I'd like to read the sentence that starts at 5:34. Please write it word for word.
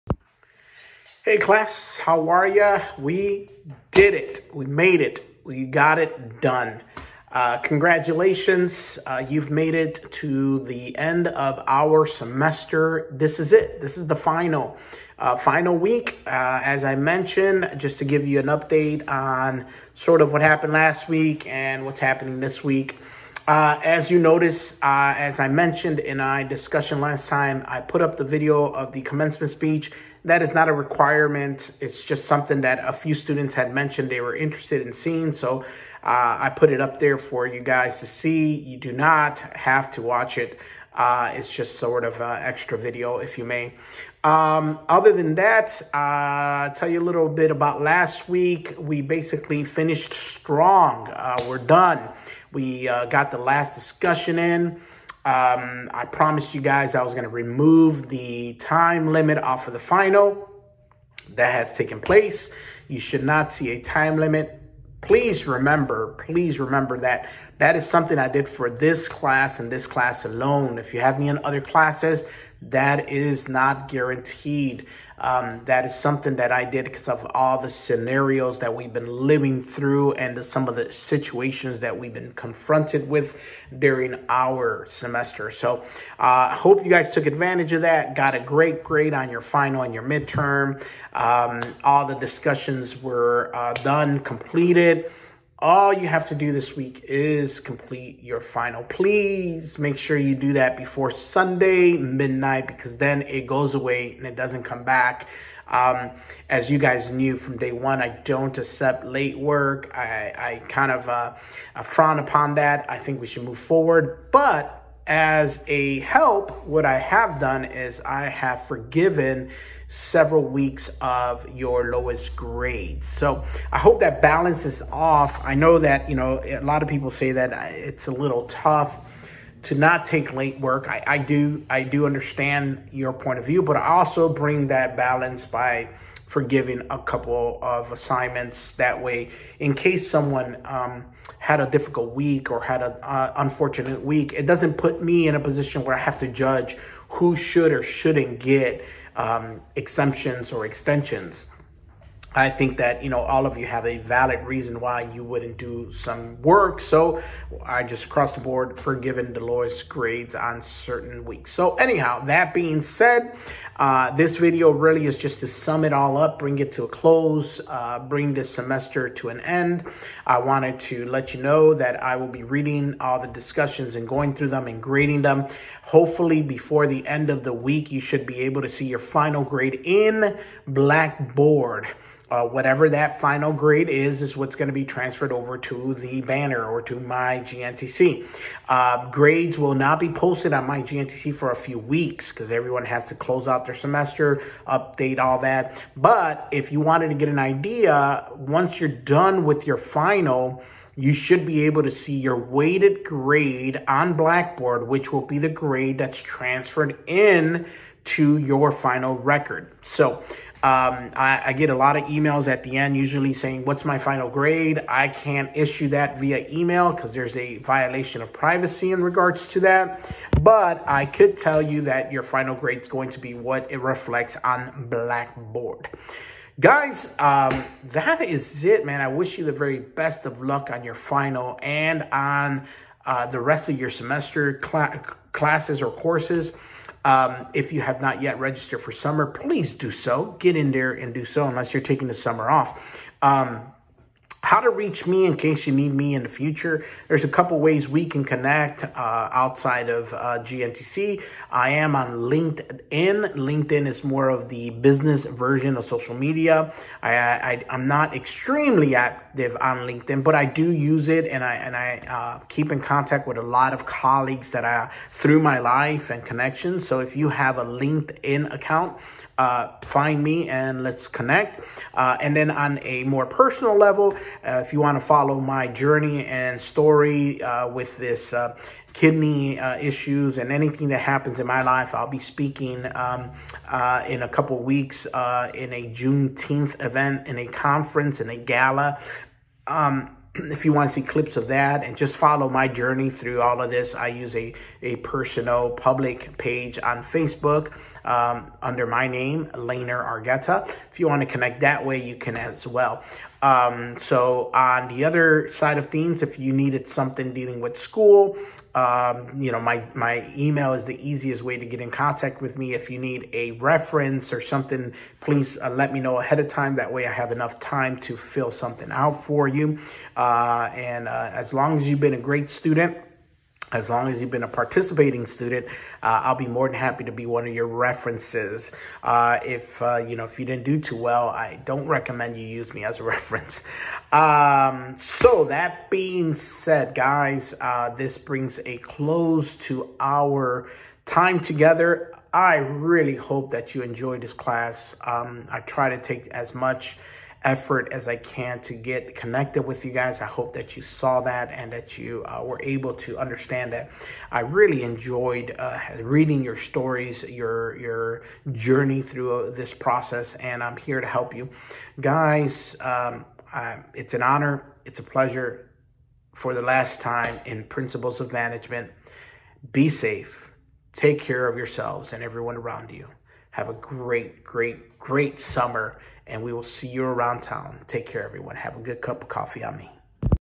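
Um, so that being said, guys, uh, this brings a close to our time together.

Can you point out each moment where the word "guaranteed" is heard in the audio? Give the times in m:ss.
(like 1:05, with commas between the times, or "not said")
1:13.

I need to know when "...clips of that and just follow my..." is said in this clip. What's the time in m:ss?
4:51.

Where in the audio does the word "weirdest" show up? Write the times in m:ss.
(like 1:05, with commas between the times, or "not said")
not said.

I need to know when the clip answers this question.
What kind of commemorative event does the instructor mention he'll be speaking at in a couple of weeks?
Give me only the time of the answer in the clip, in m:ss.
4:45.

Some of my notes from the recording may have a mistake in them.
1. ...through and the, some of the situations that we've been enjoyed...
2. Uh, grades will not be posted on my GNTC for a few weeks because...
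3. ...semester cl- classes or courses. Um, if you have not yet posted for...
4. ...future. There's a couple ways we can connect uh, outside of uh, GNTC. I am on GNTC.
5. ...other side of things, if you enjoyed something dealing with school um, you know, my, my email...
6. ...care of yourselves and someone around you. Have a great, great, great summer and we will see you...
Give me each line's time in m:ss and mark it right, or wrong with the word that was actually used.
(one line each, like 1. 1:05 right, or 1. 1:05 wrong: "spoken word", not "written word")
1. 1:19 wrong: "confronted", not "enjoyed"
2. 3:08 right
3. 3:53 wrong: "registered", not "posted"
4. 4:06 wrong: "LinkedIn", not "GNTC"
5. 5:05 wrong: "needed", not "enjoyed"
6. 6:11 wrong: "everyone", not "someone".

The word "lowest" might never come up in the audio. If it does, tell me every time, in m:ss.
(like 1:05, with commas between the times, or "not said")
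2:01, 2:39.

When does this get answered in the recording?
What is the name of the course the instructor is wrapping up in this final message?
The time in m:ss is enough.
6:07.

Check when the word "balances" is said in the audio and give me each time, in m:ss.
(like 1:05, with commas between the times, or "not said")
2:04, 2:14.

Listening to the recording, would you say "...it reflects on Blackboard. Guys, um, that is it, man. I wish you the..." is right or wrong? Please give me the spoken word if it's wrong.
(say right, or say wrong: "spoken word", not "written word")
right.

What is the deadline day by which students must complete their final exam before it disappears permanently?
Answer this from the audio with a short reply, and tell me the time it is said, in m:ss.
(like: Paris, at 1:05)
Sunday midnight, at 1:41.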